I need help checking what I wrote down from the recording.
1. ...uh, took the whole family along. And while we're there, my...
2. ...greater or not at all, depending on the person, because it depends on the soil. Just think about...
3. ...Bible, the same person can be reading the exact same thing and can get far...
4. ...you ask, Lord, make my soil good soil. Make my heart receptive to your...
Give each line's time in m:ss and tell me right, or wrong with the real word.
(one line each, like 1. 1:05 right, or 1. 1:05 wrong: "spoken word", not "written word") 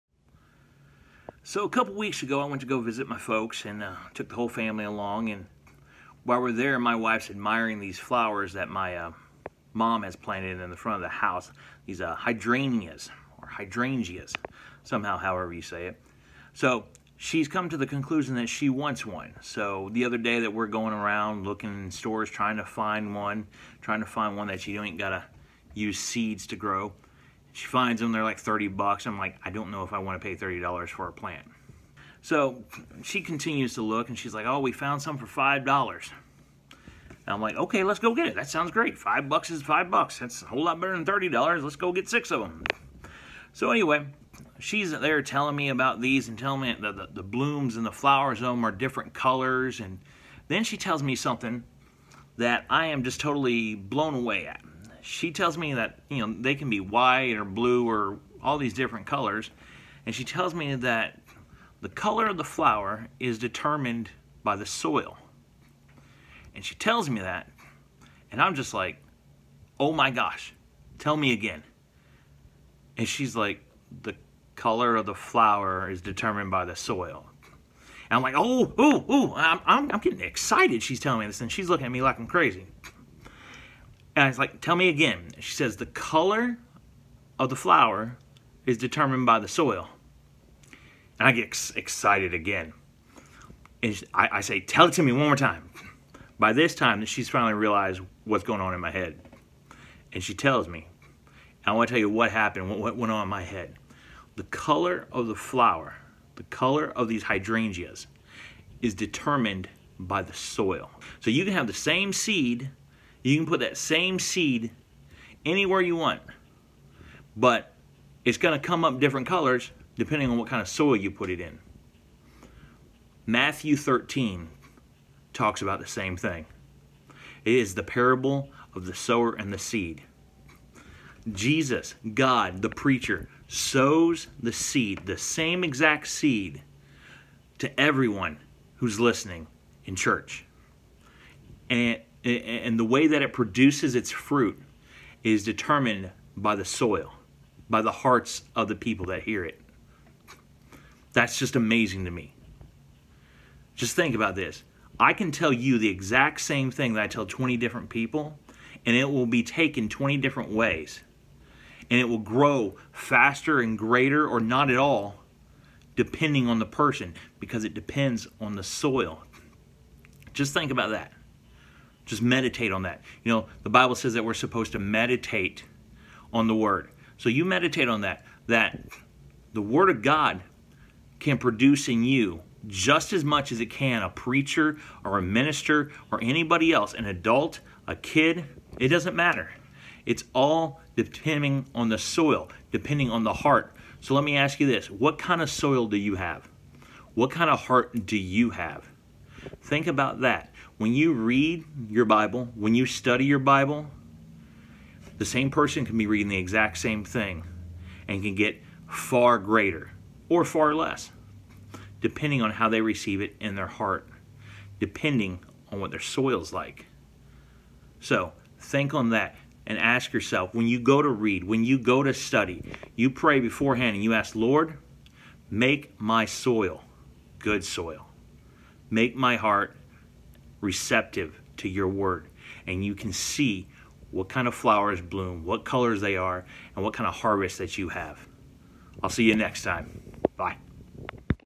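1. 0:03 right
2. 2:43 right
3. 3:23 right
4. 3:44 right.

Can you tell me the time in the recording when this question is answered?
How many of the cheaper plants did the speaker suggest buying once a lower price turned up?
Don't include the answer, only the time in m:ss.
0:42.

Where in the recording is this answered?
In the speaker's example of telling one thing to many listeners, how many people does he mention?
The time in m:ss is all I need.
2:37.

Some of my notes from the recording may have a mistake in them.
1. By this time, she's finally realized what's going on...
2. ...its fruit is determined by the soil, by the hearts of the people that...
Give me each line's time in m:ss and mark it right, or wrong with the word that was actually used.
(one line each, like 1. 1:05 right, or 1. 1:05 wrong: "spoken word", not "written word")
1. 1:36 right
2. 2:23 right.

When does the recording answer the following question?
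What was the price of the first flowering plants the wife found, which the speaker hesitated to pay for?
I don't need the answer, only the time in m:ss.
0:28.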